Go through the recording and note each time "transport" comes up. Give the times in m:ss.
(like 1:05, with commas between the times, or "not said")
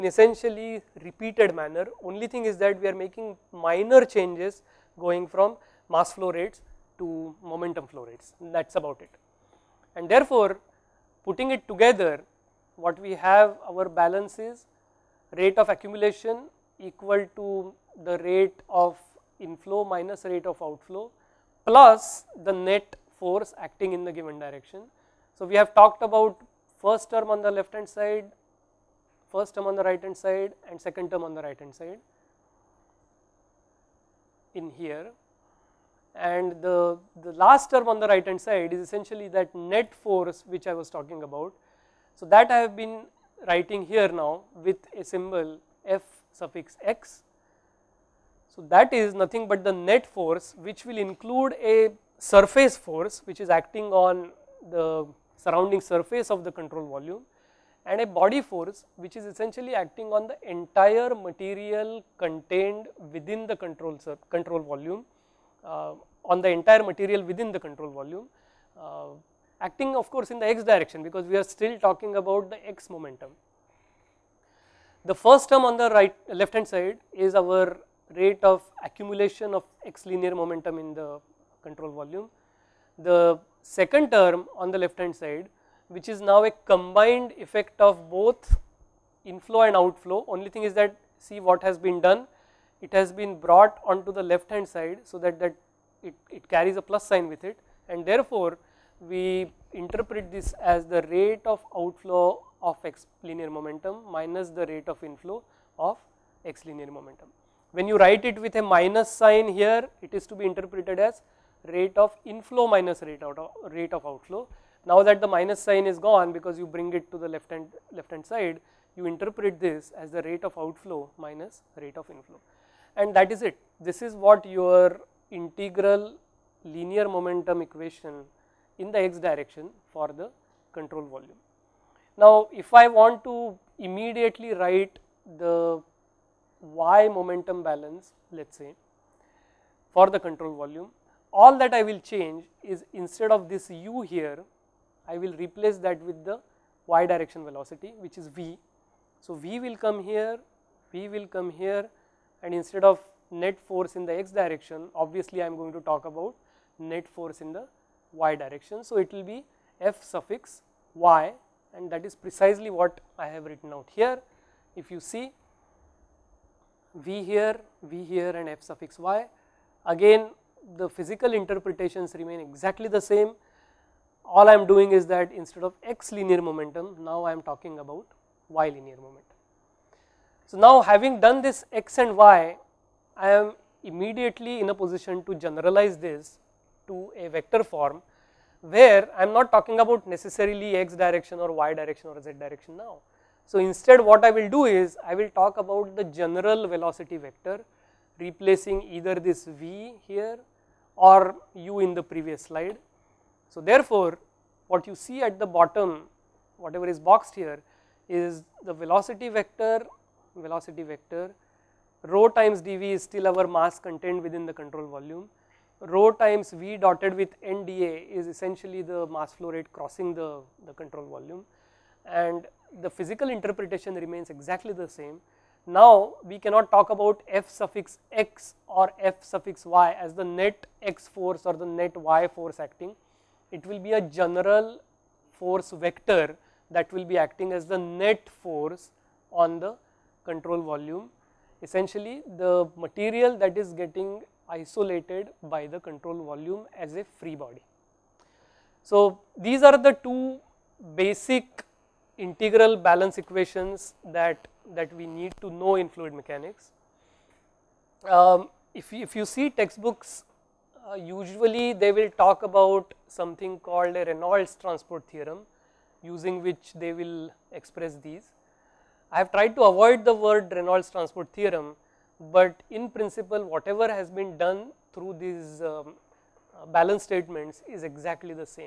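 4:24, 4:30.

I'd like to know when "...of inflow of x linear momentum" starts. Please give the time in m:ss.
1:44.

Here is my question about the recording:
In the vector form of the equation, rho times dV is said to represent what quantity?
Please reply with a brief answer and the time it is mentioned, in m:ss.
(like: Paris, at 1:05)
mass contained within the control volume, at 3:33.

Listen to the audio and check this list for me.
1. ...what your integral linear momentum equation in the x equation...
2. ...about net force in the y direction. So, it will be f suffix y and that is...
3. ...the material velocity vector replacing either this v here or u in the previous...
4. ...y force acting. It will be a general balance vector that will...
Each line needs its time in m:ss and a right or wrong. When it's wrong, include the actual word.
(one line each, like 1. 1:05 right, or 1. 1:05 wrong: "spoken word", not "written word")
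1. 2:04 wrong: "direction", not "equation"
2. 2:36 right
3. 3:15 wrong: "general", not "material"
4. 3:51 wrong: "force", not "balance".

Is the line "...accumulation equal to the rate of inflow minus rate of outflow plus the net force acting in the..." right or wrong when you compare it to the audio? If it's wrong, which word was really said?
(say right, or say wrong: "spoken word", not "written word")
right.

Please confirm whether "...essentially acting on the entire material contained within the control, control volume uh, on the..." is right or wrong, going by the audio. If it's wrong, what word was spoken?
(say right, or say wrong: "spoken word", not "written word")
right.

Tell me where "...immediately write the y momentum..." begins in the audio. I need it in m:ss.
2:13.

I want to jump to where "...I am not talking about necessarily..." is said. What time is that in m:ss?
3:09.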